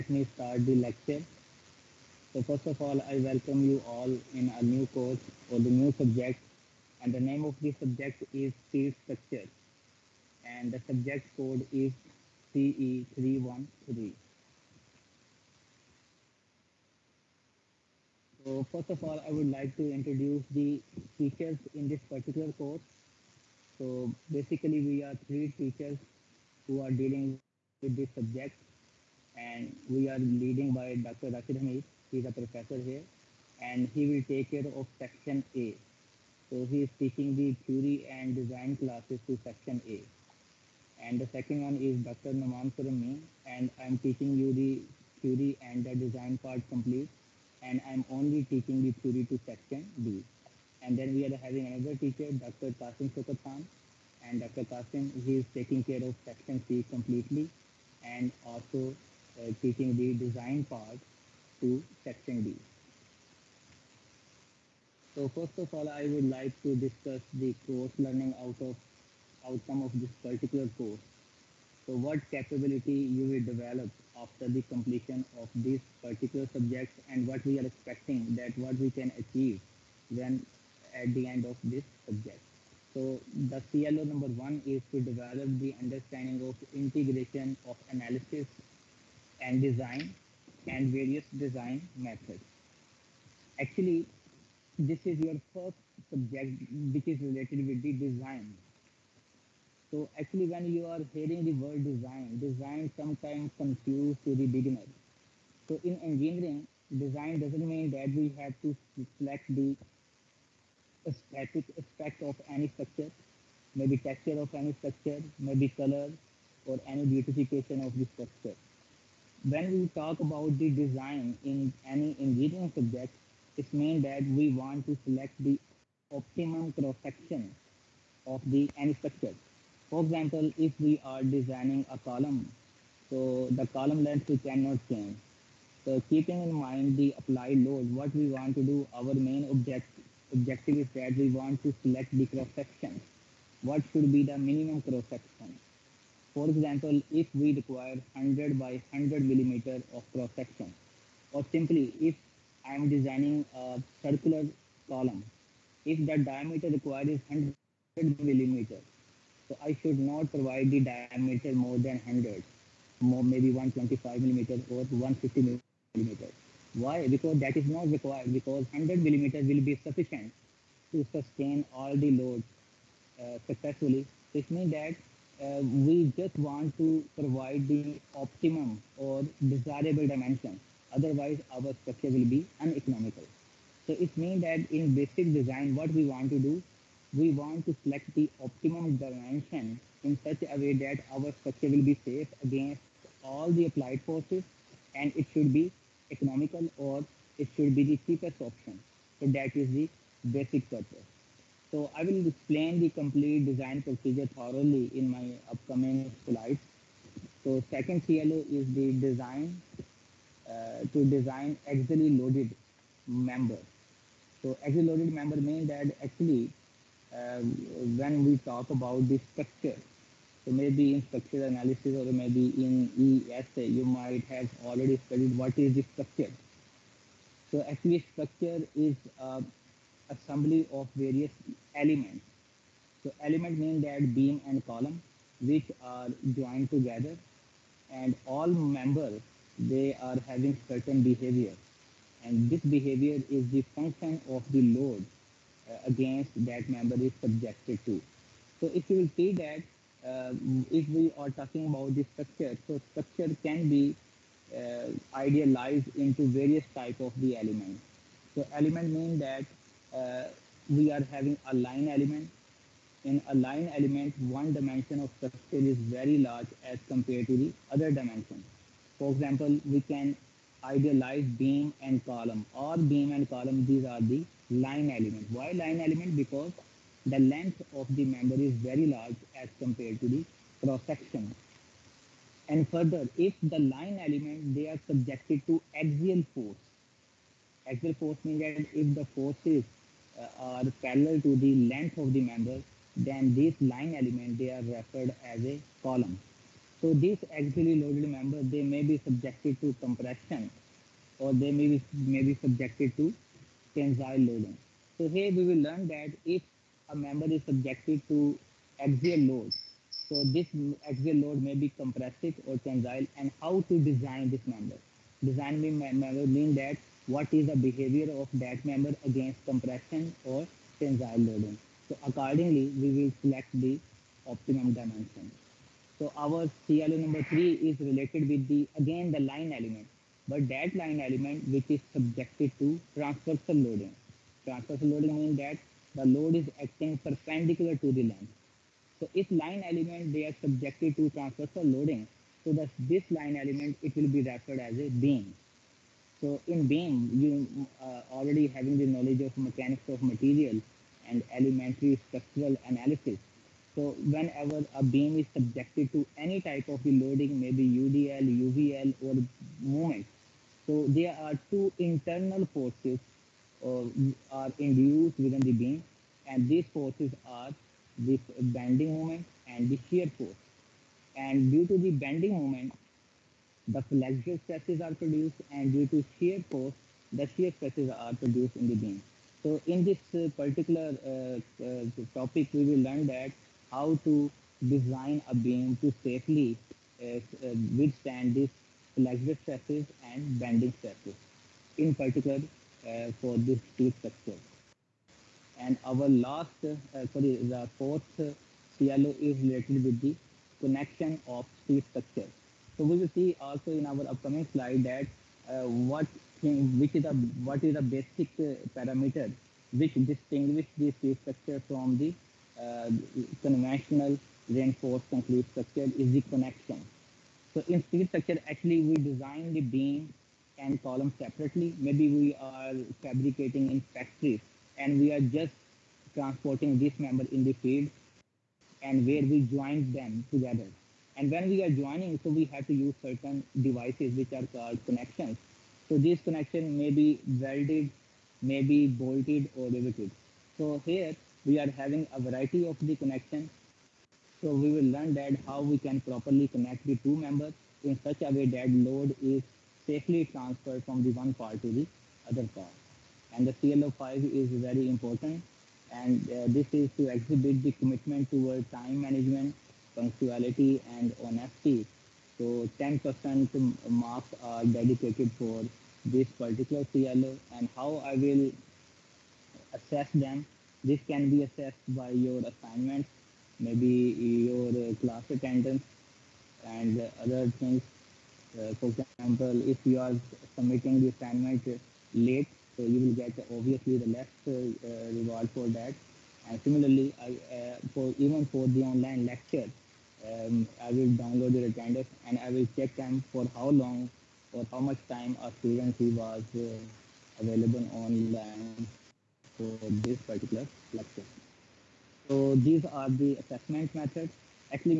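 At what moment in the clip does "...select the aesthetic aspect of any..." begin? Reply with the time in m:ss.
1:49.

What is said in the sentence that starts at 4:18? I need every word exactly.
So element mean that uh, we are having a line element.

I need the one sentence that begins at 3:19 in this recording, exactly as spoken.
So that is the basic purpose.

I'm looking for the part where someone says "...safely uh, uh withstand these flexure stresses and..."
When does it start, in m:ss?
6:26.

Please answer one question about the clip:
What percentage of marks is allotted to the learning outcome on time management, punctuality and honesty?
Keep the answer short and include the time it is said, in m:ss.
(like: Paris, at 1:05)
10%, at 7:42.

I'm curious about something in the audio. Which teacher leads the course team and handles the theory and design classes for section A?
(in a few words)
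Dr. Rashid Hamid.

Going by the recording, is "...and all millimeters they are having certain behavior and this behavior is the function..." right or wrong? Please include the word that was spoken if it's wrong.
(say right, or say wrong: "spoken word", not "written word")
wrong: "members", not "millimeters".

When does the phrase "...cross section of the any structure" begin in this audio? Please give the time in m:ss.
2:06.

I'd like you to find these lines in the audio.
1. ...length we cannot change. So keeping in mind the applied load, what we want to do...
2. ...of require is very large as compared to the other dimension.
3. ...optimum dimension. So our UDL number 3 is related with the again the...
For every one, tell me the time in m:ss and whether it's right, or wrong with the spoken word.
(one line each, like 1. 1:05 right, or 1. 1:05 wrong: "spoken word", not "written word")
1. 2:14 right
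2. 4:24 wrong: "structure", not "require"
3. 5:24 wrong: "CLO", not "UDL".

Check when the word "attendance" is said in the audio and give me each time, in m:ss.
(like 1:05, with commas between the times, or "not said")
7:55, 8:11.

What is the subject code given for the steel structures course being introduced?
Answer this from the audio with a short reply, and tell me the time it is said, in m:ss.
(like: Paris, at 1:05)
CE313, at 0:12.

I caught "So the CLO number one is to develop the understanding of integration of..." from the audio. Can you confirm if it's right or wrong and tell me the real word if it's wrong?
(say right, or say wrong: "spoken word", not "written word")
right.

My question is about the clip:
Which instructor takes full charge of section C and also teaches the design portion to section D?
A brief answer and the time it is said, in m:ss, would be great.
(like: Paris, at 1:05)
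Dr. Kasim Sokatan, at 0:52.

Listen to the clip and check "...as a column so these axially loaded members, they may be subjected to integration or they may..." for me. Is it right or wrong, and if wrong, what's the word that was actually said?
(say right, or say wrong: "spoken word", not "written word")
wrong: "compression", not "integration".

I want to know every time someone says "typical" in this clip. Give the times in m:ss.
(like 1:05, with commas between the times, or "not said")
not said.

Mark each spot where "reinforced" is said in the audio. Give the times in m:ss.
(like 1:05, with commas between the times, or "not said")
6:54.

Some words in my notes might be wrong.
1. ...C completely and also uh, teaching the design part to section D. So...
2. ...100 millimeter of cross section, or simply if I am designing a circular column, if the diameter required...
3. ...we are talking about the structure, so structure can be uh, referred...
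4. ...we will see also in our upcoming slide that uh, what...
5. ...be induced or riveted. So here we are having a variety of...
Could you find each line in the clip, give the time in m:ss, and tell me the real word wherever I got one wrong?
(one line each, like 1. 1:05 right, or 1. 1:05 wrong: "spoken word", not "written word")
1. 0:56 right
2. 2:28 right
3. 4:10 wrong: "idealized", not "referred"
4. 6:42 right
5. 7:18 wrong: "bolted", not "induced".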